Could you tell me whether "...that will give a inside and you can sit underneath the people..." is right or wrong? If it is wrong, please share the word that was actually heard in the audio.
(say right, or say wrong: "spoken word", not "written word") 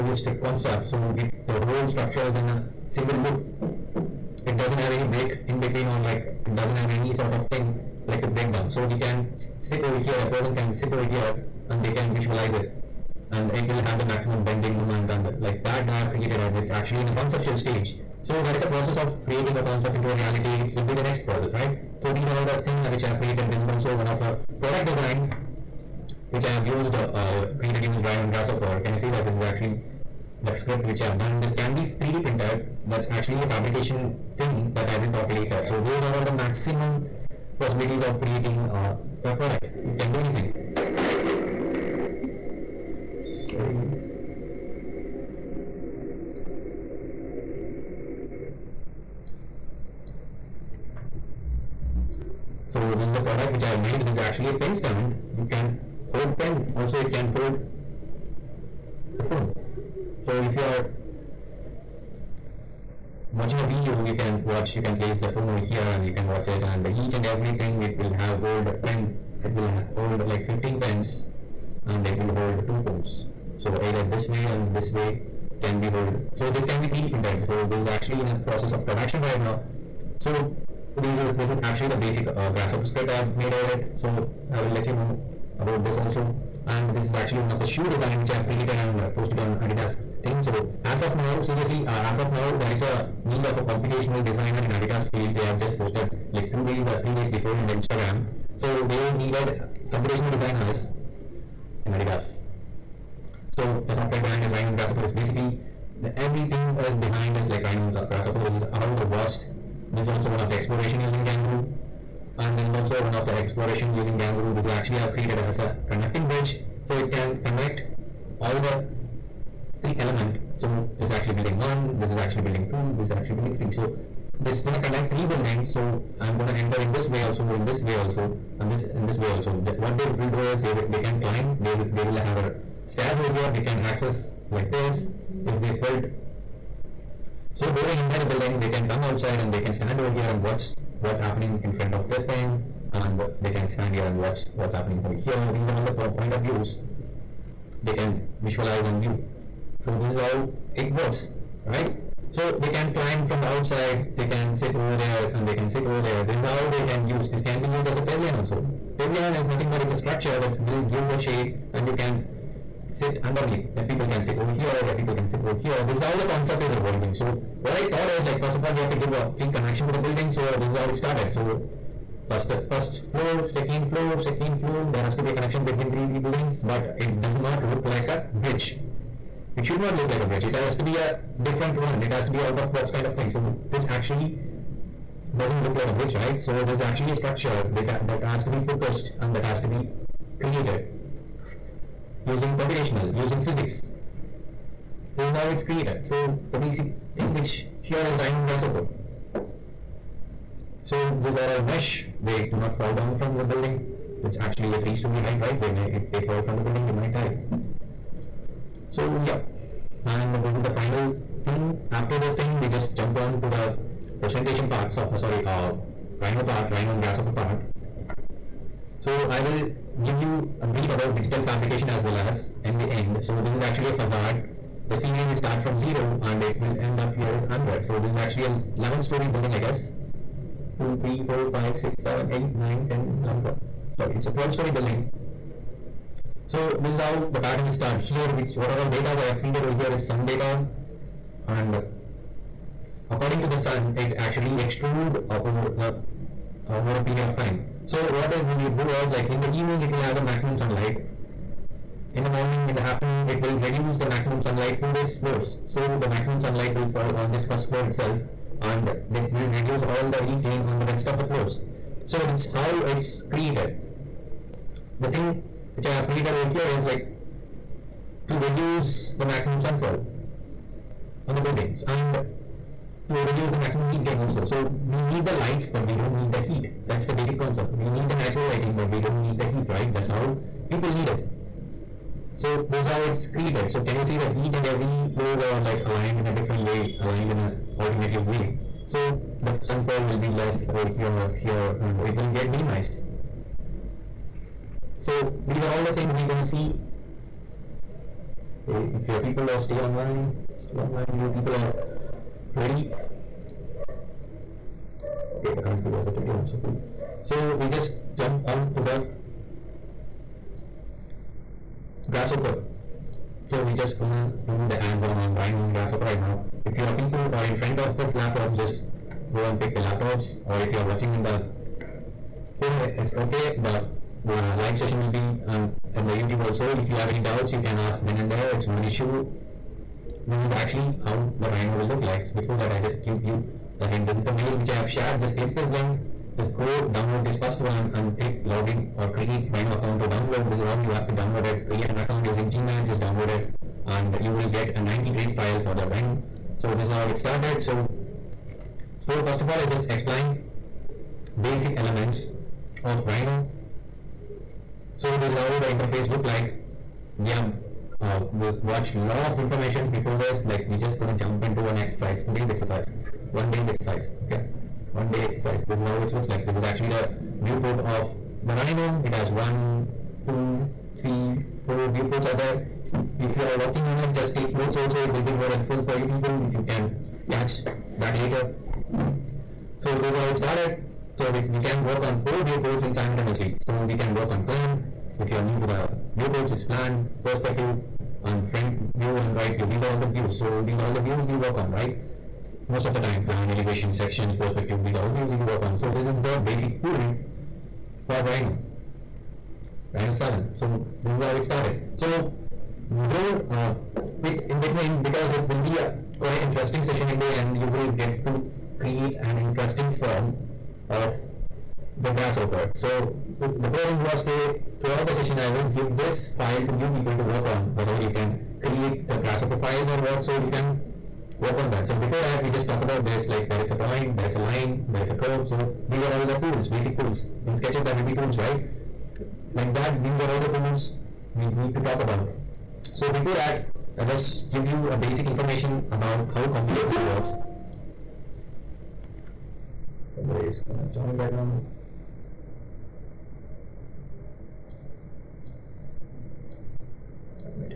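wrong: "shade", not "inside".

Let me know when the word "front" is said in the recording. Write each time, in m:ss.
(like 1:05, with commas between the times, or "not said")
2:21, 5:17, 6:28.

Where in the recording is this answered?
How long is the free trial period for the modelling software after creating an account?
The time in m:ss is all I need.
5:44.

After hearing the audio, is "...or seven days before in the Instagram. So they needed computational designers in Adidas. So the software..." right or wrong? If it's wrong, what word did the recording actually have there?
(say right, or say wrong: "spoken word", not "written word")
wrong: "three", not "seven".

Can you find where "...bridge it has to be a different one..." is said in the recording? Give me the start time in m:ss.
3:00.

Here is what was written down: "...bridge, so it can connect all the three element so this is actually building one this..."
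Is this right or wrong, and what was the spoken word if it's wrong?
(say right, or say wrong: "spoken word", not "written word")
right.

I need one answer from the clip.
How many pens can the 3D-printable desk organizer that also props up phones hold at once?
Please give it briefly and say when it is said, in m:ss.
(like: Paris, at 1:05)
15, at 1:10.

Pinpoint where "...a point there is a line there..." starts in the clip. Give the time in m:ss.
7:03.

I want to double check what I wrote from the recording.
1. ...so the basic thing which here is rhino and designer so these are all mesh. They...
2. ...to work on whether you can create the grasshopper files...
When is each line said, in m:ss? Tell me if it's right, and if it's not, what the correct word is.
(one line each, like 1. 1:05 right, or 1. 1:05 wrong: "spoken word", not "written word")
1. 3:16 wrong: "grasshopper", not "designer"
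2. 6:57 right.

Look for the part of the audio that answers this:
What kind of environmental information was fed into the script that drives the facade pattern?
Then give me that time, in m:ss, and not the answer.
4:00.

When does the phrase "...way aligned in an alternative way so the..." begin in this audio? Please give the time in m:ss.
4:46.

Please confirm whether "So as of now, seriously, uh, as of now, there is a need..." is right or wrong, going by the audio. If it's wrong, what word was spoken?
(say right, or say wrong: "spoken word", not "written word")
right.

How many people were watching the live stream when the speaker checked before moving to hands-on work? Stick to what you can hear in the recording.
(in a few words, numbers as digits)
21.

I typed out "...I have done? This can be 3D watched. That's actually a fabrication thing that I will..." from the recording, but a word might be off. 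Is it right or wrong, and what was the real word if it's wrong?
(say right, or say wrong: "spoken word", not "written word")
wrong: "printed", not "watched".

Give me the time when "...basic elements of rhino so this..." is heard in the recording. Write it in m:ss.
5:51.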